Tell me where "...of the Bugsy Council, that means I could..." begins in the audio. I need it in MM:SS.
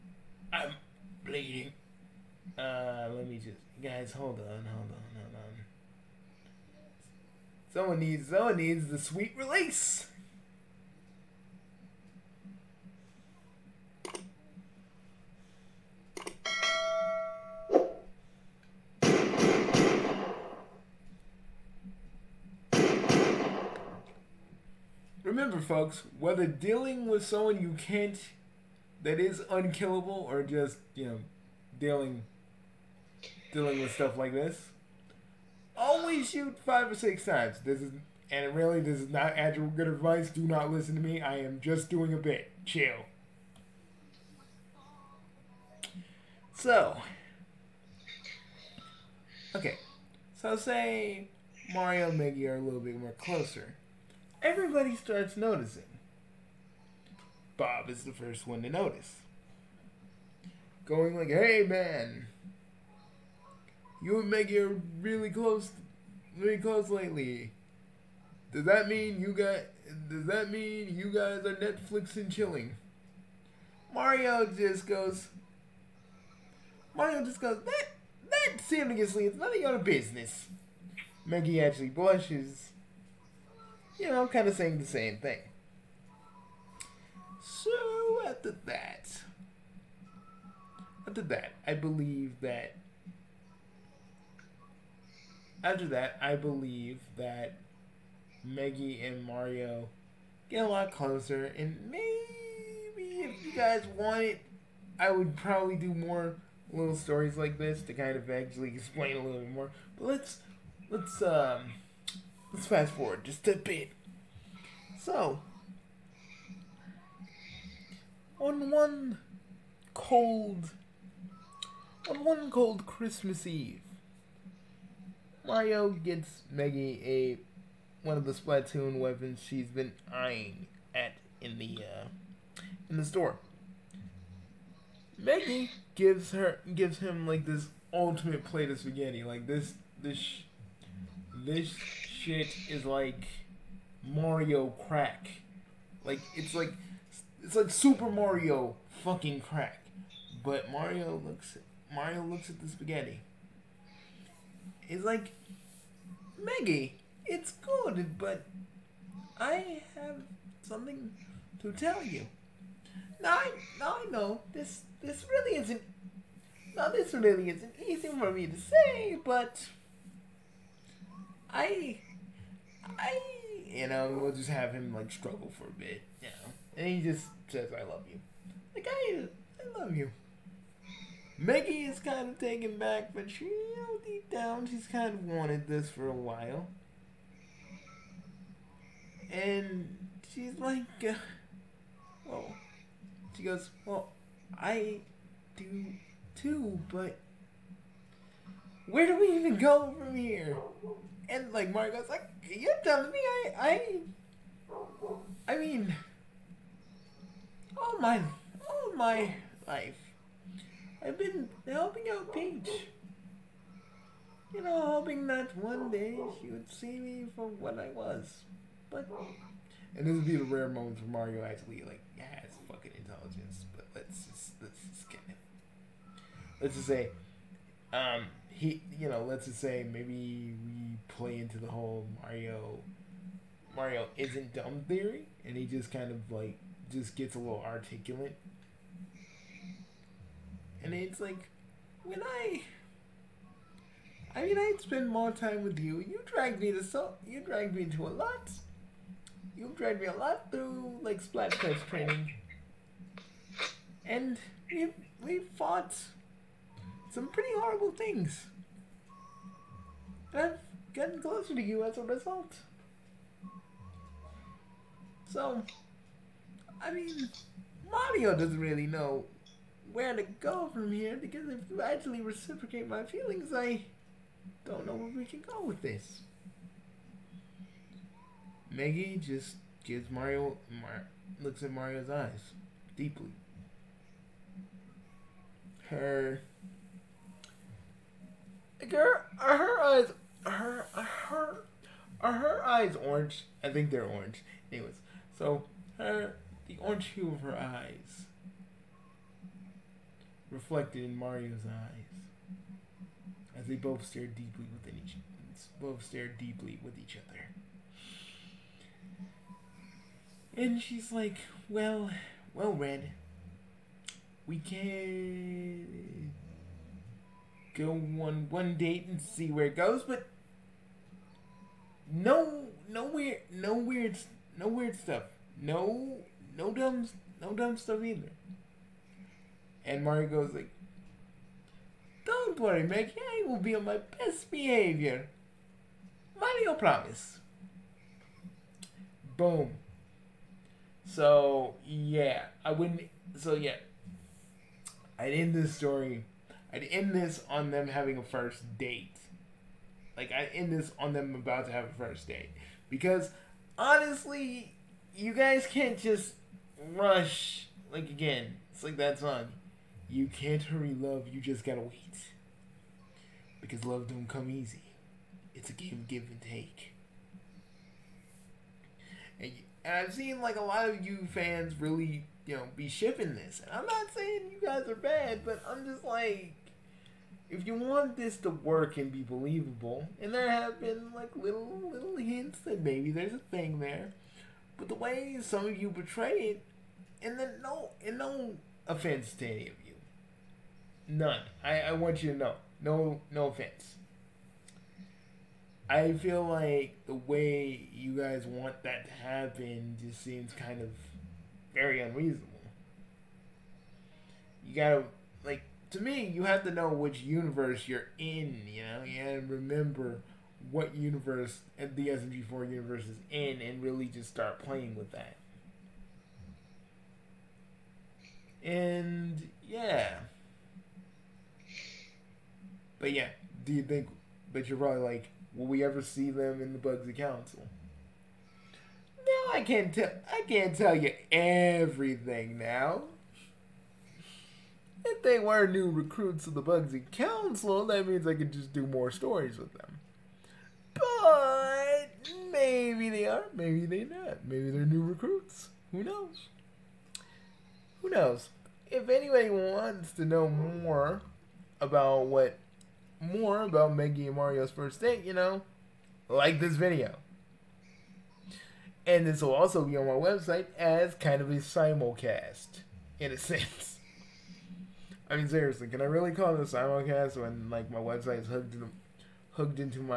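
07:16.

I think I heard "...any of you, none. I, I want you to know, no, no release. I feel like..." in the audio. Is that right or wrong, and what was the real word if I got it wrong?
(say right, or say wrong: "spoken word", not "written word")
wrong: "offense", not "release".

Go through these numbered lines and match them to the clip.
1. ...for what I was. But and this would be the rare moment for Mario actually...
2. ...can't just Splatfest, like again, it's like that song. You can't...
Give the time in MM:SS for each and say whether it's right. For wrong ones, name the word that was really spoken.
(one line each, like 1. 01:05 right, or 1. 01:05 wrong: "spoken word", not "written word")
1. 03:37 right
2. 05:55 wrong: "Rush", not "Splatfest".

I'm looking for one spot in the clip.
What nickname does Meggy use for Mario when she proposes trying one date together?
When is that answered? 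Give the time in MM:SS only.
05:12.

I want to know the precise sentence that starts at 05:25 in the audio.
No no dumb, no dumb stuff either.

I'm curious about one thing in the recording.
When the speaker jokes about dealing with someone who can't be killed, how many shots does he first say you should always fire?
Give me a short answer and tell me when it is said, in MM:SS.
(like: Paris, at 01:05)
5, at 00:36.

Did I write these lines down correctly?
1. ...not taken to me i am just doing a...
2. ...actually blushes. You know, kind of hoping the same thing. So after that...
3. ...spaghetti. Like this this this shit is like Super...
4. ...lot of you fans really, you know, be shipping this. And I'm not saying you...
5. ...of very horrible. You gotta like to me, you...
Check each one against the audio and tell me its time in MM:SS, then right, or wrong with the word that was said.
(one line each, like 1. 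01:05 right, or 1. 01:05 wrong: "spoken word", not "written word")
1. 00:40 wrong: "listen", not "taken"
2. 01:21 wrong: "saying", not "hoping"
3. 02:18 wrong: "Mario", not "Super"
4. 06:10 right
5. 06:40 wrong: "unreasonable", not "horrible".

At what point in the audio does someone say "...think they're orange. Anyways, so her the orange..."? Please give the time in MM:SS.
04:53.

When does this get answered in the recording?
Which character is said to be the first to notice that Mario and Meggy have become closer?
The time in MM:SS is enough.
00:57.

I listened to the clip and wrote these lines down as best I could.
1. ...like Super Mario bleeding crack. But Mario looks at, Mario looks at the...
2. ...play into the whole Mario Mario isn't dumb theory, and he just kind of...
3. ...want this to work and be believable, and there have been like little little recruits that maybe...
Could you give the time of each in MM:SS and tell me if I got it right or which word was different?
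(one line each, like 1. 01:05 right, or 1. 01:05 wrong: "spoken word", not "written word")
1. 02:27 wrong: "fucking", not "bleeding"
2. 03:51 right
3. 06:17 wrong: "hints", not "recruits".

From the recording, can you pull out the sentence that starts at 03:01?
Meggy is kind of taken back, but she, you know, deep down, she's kind of wanted this for a while.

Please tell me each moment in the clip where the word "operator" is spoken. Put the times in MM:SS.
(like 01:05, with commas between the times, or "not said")
not said.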